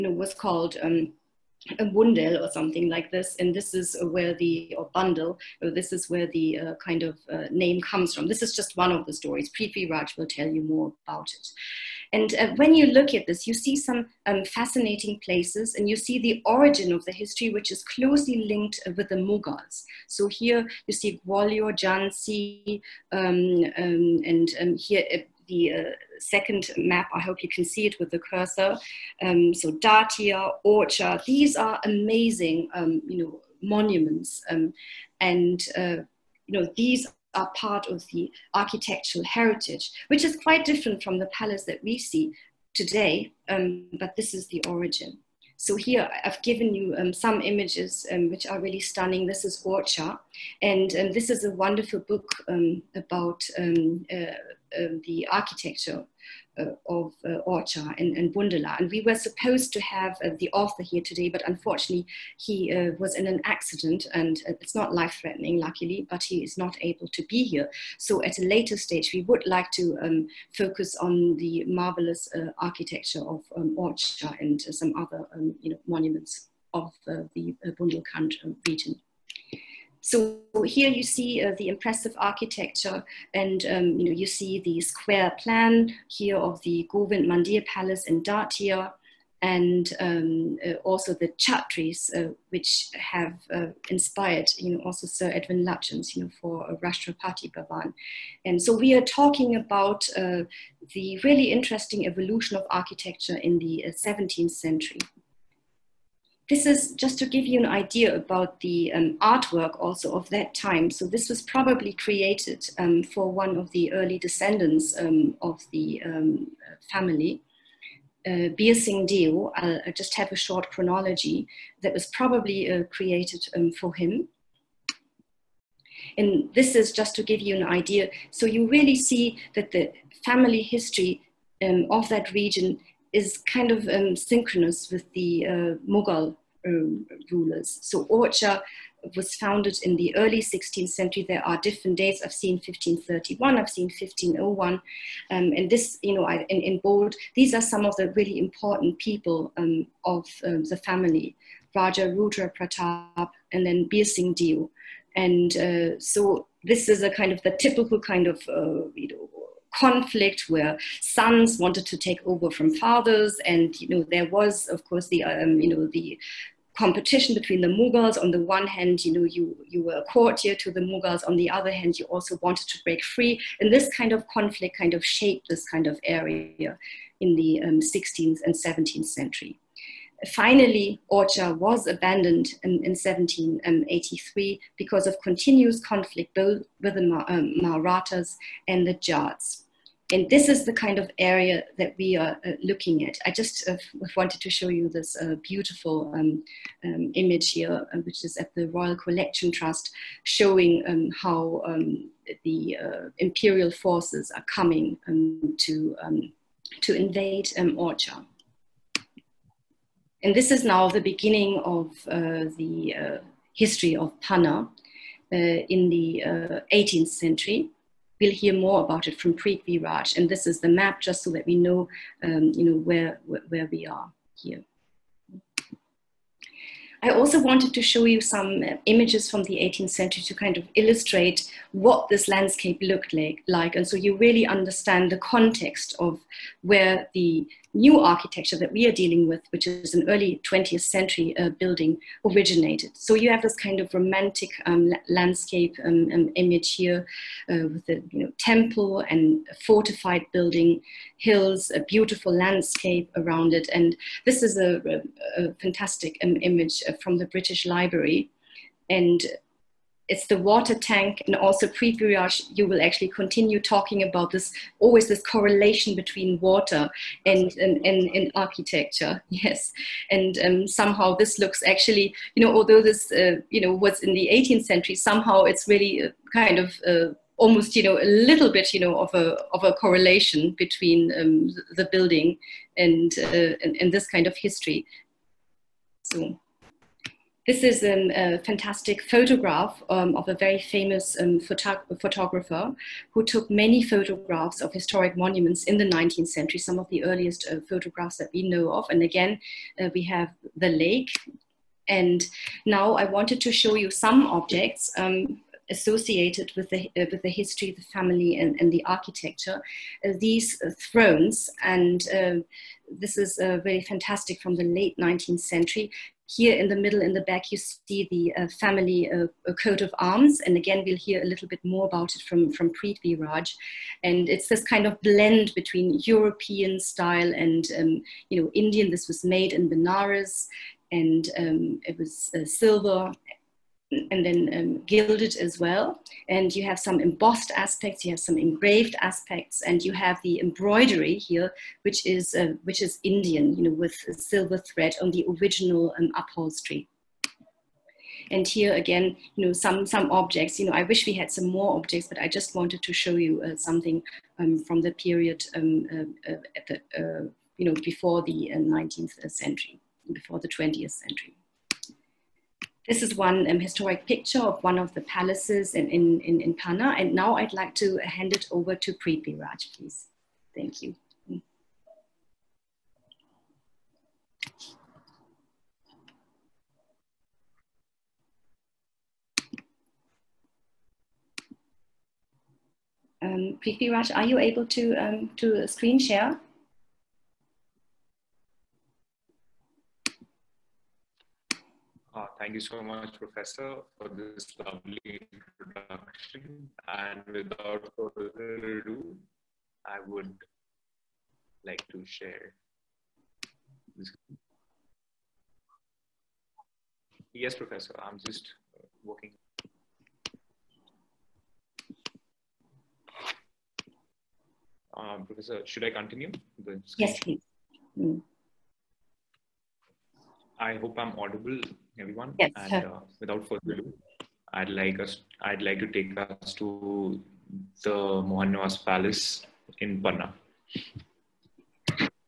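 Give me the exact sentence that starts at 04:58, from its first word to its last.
And again, uh, we have the lake.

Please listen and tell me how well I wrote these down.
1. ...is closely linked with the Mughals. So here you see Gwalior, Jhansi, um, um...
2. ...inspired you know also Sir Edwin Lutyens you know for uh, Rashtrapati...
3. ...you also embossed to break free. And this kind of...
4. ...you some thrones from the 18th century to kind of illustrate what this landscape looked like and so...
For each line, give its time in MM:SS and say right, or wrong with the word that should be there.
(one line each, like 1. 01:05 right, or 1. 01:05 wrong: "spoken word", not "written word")
1. 00:17 right
2. 01:33 right
3. 02:51 wrong: "wanted", not "embossed"
4. 03:48 wrong: "images", not "thrones".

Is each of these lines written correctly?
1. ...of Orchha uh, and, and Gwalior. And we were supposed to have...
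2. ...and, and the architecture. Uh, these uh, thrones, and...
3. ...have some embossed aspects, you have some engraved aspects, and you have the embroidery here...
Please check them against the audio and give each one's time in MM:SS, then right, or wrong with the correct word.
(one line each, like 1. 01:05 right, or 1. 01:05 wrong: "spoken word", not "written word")
1. 00:56 wrong: "Bundela", not "Gwalior"
2. 05:08 right
3. 05:36 right.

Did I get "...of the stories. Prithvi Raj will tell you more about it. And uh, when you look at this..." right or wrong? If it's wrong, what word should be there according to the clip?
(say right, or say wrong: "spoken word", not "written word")
right.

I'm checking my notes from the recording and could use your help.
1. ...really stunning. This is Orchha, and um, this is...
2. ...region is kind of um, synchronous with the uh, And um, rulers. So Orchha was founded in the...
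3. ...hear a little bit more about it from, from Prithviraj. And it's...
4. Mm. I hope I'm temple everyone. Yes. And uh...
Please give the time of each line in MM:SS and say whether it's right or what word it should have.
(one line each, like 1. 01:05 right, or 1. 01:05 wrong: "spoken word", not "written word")
1. 00:48 right
2. 02:12 wrong: "Mughal", not "And"
3. 05:20 right
4. 06:57 wrong: "audible", not "temple".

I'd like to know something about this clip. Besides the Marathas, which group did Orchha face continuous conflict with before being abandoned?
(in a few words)
the Jats.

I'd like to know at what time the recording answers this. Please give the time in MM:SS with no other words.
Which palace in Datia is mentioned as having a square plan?
01:26.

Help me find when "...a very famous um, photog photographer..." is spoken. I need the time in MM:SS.
04:50.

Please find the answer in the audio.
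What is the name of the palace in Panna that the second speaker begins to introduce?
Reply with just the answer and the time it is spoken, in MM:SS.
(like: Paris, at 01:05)
Mohan Niwas Palace, at 07:08.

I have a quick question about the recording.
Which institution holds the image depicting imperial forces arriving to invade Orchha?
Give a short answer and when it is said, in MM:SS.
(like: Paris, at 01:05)
Royal Collection Trust, at 03:18.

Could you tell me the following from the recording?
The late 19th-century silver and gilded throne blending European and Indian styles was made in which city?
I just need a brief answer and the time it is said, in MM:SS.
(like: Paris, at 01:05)
Benares, at 05:29.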